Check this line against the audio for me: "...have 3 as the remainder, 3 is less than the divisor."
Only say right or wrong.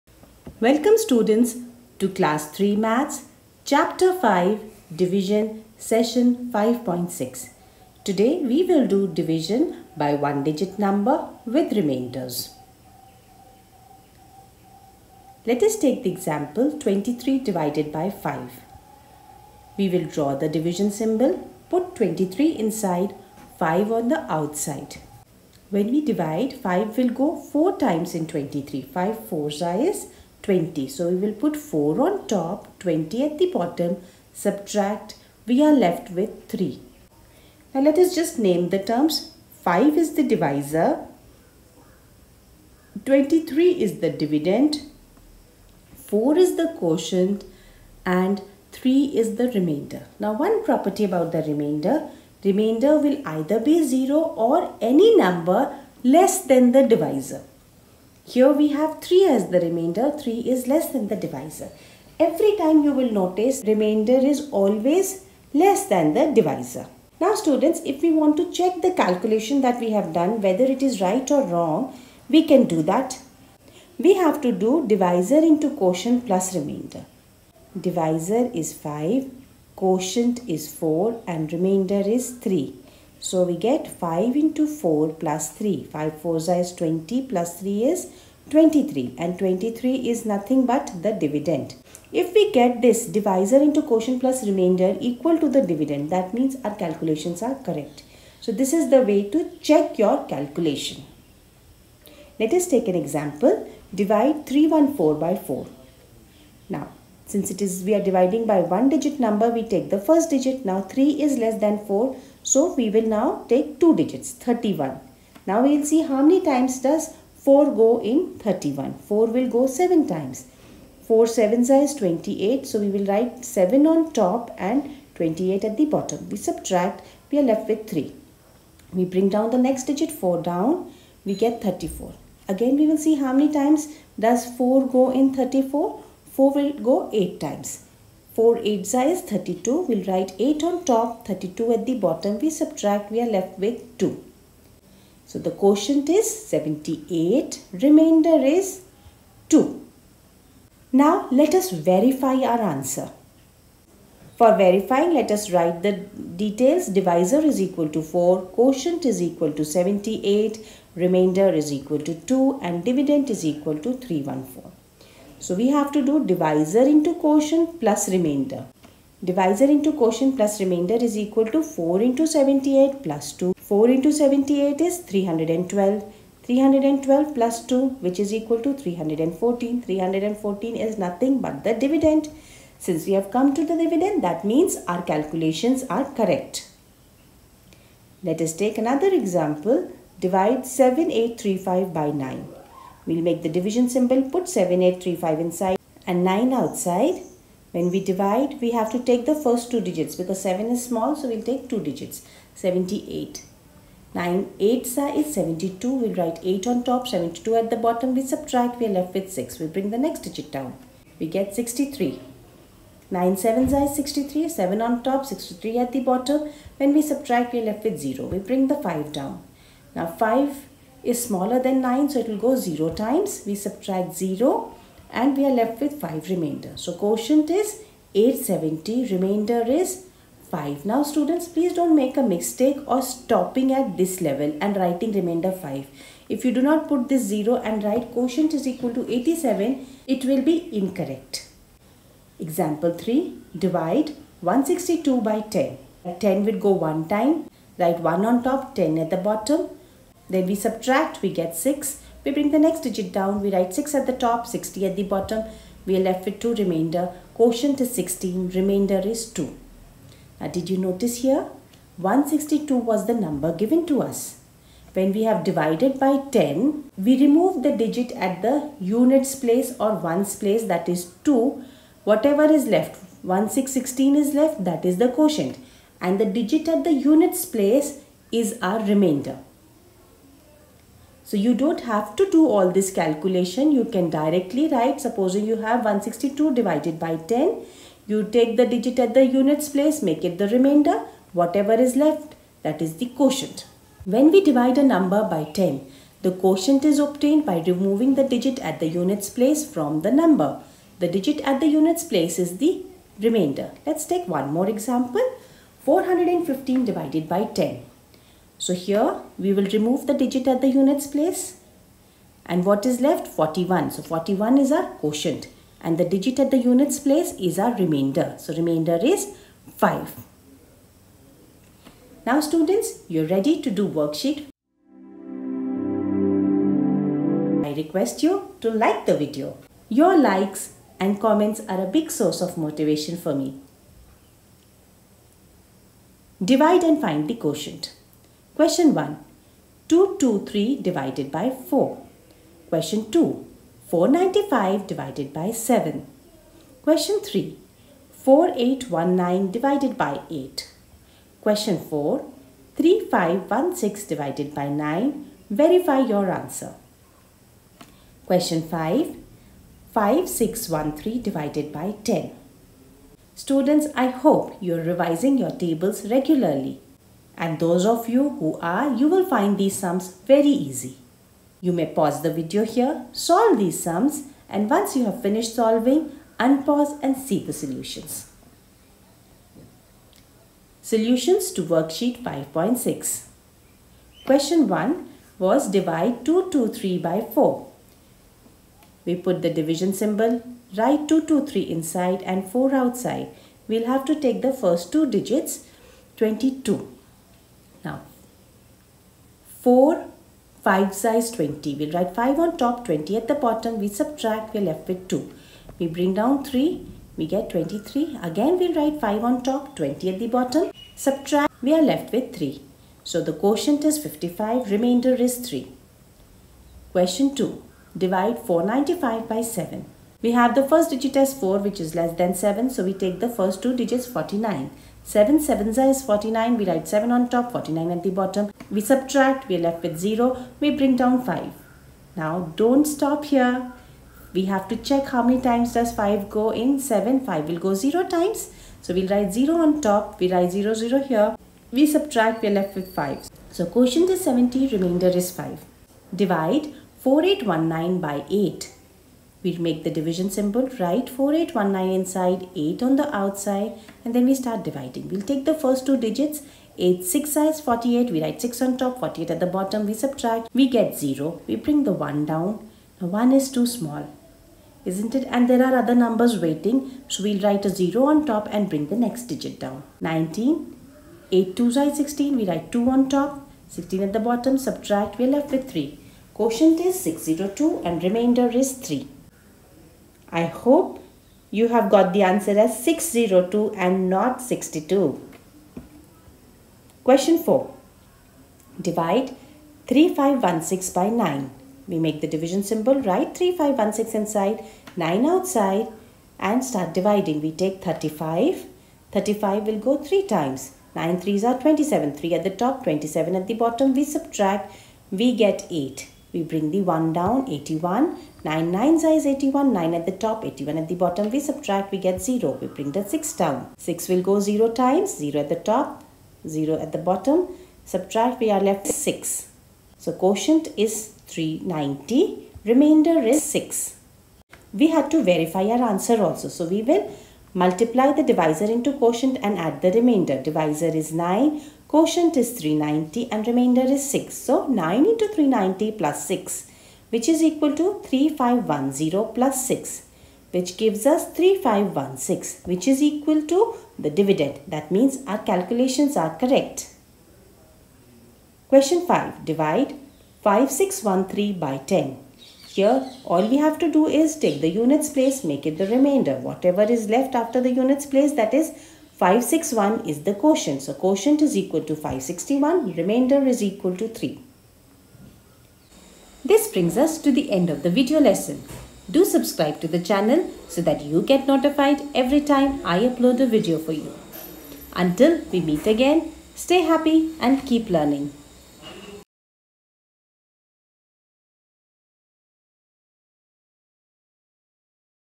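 right.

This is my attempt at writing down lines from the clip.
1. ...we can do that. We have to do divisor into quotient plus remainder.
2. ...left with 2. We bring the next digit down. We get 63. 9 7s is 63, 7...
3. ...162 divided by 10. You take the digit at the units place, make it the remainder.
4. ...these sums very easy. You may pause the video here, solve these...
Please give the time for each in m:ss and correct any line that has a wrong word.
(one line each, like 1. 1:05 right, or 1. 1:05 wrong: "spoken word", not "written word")
1. 1:12 right
2. 3:28 wrong: "6", not "2"
3. 4:45 right
4. 6:09 right.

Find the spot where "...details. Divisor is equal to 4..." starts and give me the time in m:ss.
2:36.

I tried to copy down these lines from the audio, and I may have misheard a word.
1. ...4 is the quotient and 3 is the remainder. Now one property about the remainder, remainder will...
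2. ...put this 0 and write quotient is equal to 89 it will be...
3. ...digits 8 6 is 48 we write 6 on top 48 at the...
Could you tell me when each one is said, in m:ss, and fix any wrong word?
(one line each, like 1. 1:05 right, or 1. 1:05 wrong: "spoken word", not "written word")
1. 0:45 right
2. 3:56 wrong: "87", not "89"
3. 7:35 right.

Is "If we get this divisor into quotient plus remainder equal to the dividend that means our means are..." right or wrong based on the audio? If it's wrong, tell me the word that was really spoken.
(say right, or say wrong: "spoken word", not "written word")
wrong: "calculations", not "means".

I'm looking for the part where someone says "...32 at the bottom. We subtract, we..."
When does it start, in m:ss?
2:21.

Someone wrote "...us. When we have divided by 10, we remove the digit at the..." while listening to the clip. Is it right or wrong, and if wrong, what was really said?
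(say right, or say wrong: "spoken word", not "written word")
right.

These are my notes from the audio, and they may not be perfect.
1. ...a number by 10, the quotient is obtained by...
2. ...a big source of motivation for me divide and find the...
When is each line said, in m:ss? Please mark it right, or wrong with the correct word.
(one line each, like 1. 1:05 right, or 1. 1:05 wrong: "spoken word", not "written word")
1. 4:54 right
2. 5:31 right.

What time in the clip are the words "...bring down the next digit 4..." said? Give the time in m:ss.
2:09.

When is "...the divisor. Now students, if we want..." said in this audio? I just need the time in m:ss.
1:06.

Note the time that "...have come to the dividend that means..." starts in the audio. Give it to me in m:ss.
3:03.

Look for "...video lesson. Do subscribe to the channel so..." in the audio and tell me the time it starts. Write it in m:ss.
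9:27.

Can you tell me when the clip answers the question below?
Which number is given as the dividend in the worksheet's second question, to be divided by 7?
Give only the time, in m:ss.
5:43.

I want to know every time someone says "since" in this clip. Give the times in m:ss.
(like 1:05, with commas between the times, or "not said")
1:47, 3:02.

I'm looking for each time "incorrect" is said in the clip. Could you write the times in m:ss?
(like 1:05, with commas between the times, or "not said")
4:00.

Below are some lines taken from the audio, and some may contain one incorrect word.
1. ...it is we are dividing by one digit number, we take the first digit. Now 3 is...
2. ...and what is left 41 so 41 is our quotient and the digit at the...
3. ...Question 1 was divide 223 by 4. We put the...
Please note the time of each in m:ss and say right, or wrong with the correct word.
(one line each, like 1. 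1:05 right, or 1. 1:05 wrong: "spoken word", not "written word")
1. 1:47 right
2. 5:12 right
3. 6:24 right.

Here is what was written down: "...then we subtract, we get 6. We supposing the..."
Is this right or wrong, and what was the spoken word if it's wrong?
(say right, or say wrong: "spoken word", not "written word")
wrong: "bring", not "supposing".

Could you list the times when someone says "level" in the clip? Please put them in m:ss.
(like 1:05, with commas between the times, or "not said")
3:54.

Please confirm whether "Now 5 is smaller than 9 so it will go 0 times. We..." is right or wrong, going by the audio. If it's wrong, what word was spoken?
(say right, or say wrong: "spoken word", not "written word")
right.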